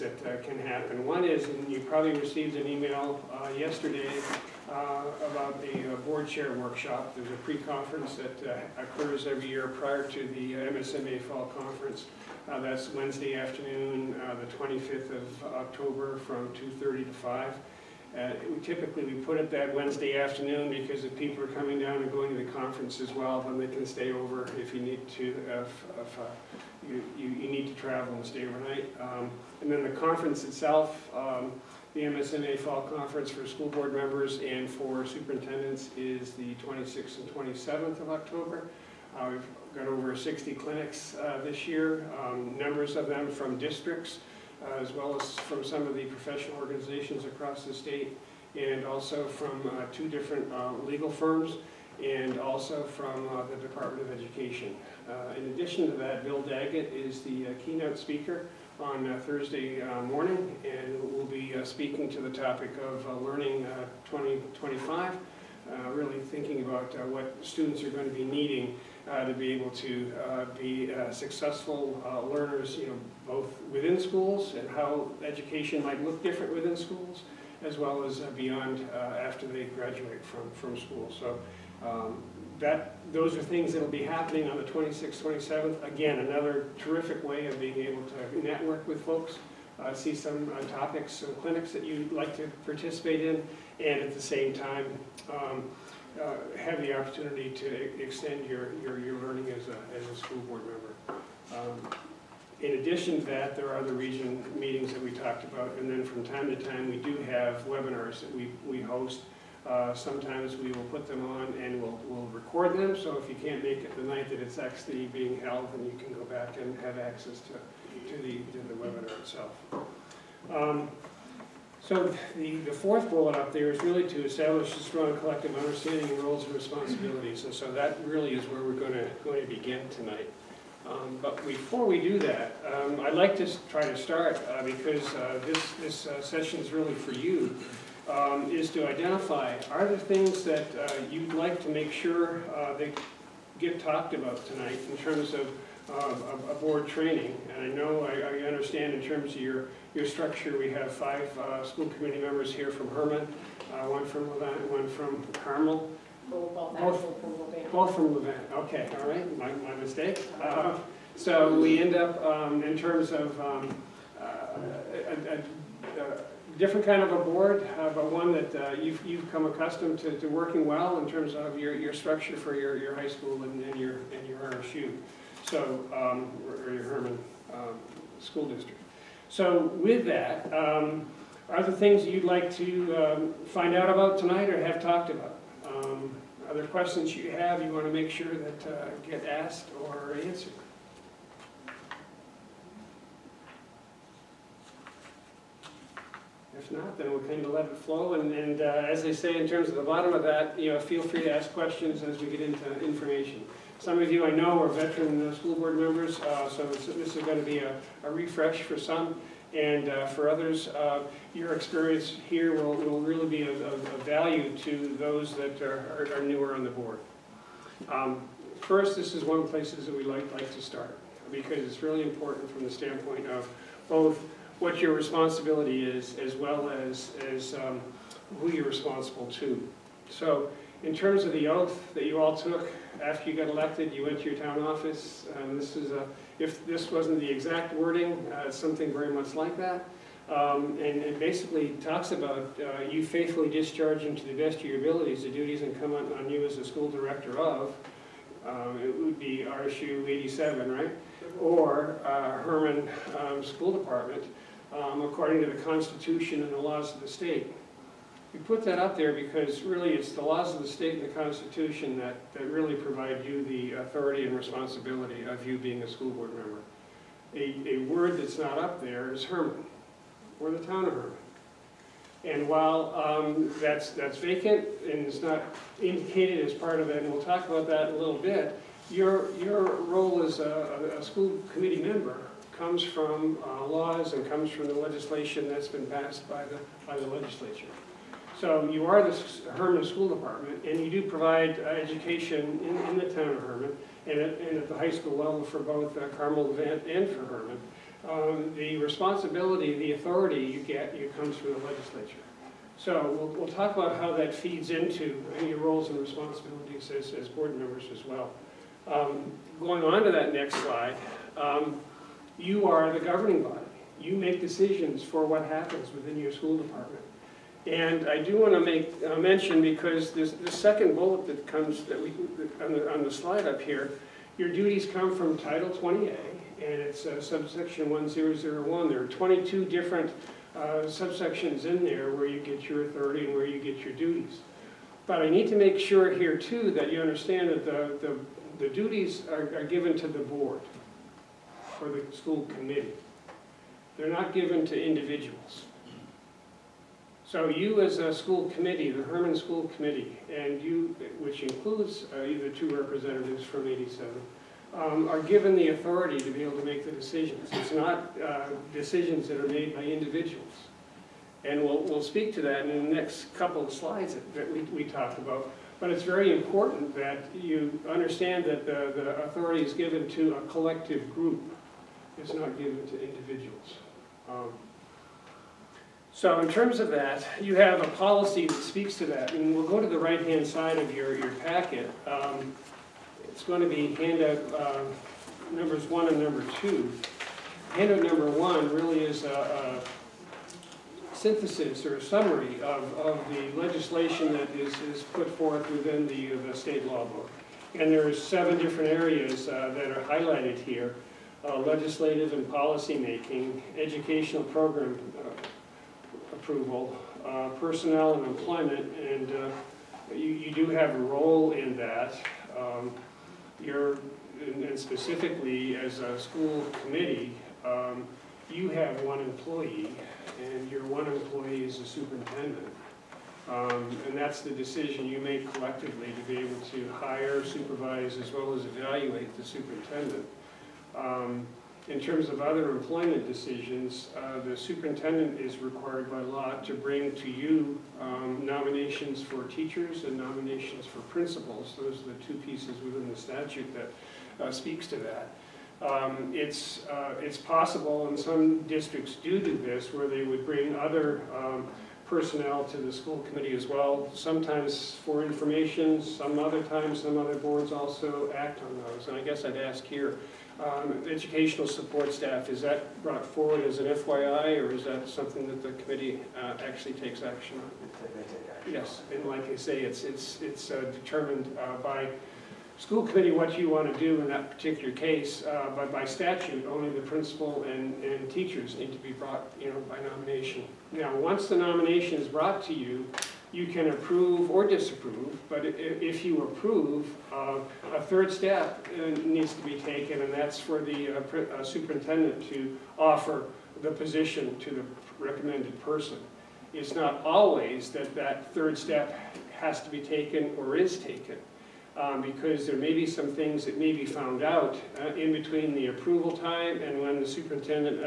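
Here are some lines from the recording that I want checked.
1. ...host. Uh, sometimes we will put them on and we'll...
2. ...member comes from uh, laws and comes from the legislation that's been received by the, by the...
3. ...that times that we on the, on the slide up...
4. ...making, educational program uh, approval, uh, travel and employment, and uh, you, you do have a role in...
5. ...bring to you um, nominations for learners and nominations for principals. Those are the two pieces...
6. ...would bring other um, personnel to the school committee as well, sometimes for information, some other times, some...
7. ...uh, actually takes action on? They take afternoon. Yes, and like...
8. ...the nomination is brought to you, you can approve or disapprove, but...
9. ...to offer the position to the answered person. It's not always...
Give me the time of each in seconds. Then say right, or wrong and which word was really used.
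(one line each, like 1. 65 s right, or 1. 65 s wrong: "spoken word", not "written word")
1. 108 s right
2. 281 s wrong: "passed", not "received"
3. 321 s wrong: "comes", not "times"
4. 402 s wrong: "personnel", not "travel"
5. 436 s wrong: "teachers", not "learners"
6. 450 s right
7. 466 s wrong: "action", not "afternoon"
8. 481 s right
9. 492 s wrong: "recommended", not "answered".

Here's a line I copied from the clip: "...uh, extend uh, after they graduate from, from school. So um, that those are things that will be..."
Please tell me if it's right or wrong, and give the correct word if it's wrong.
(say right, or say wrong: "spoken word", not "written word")
wrong: "beyond", not "extend".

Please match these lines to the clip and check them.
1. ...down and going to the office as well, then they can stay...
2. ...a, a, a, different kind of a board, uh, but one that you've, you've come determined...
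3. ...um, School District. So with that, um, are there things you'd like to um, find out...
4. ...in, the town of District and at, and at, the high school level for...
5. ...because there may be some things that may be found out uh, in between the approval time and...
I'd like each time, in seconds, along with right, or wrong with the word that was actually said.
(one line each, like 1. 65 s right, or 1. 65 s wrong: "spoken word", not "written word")
1. 21 s wrong: "conference", not "office"
2. 165 s wrong: "accustomed", not "determined"
3. 177 s right
4. 292 s wrong: "Hermon", not "District"
5. 502 s right.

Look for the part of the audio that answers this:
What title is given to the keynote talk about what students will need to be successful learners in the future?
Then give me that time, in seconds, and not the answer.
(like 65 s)
63 s.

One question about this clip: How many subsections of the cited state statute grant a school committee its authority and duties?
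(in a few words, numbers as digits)
22.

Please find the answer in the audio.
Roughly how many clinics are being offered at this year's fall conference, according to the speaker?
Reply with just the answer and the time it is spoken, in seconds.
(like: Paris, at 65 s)
over 60, at 39 s.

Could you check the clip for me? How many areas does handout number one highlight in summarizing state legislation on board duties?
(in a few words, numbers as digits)
7.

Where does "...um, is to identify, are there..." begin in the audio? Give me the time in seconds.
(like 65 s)
138 s.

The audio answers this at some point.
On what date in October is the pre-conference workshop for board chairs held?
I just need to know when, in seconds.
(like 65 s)
14 s.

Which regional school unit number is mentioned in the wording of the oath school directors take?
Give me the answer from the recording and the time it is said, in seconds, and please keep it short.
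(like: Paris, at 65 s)
87, at 249 s.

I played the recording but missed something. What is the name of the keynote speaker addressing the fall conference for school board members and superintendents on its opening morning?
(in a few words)
Bill Daggett.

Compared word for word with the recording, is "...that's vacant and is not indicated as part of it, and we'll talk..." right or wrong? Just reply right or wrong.
right.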